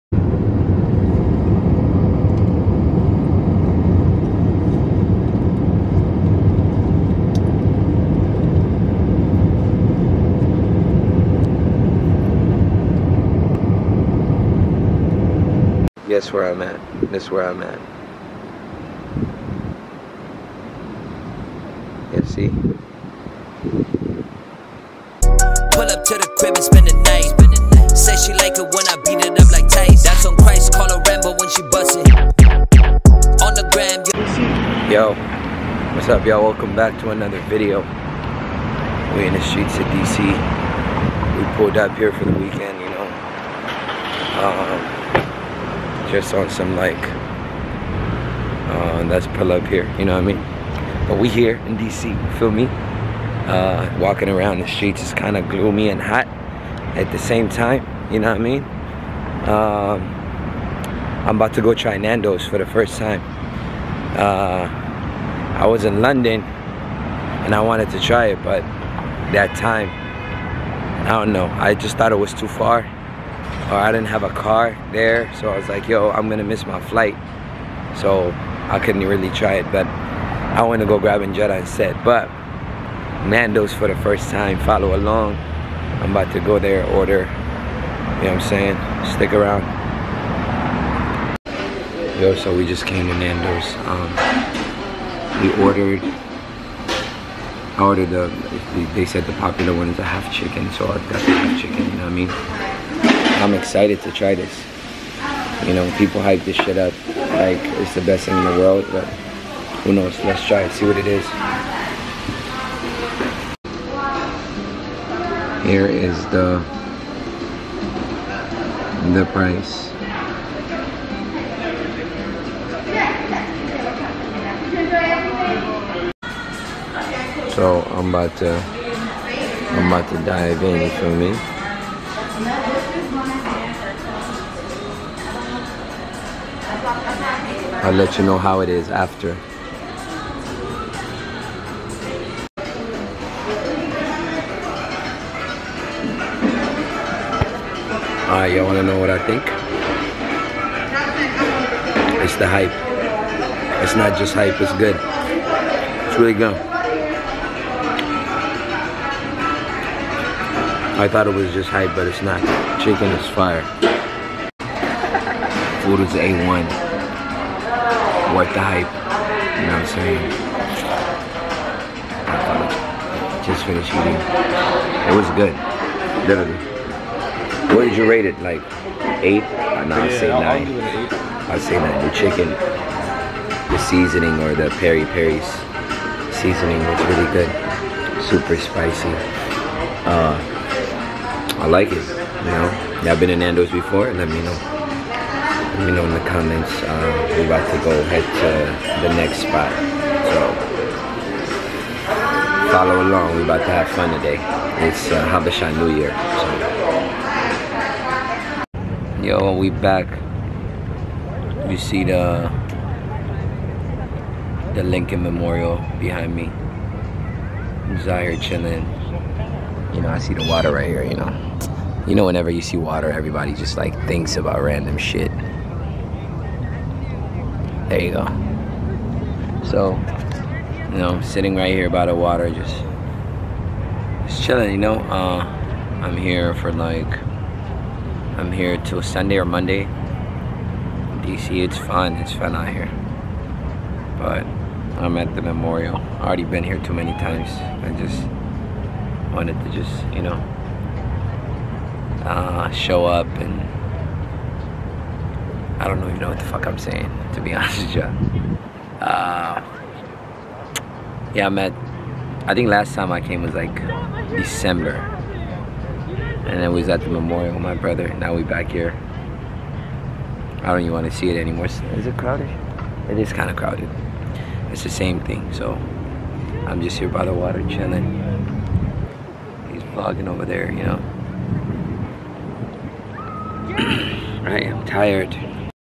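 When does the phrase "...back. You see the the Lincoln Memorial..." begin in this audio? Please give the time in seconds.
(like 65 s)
209 s.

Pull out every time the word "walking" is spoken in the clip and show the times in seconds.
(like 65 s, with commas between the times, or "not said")
53 s.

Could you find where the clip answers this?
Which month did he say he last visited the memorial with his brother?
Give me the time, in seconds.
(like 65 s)
264 s.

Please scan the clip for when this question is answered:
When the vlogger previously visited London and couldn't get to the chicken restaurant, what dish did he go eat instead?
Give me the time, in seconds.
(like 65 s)
81 s.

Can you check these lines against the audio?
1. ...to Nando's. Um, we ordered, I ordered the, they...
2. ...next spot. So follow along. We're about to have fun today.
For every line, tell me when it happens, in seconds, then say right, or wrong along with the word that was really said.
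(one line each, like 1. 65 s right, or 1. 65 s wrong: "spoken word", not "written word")
1. 93 s right
2. 199 s right.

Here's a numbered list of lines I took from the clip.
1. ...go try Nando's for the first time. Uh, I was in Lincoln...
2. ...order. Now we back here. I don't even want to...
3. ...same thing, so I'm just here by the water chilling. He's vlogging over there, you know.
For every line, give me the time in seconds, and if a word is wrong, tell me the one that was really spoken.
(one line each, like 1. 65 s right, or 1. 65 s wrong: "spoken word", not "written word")
1. 61 s wrong: "London", not "Lincoln"
2. 267 s wrong: "brother", not "order"
3. 274 s right.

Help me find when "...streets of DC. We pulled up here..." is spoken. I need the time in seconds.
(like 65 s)
39 s.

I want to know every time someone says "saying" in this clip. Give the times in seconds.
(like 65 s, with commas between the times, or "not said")
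88 s, 169 s, 256 s.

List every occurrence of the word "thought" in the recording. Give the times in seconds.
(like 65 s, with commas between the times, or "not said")
71 s, 161 s.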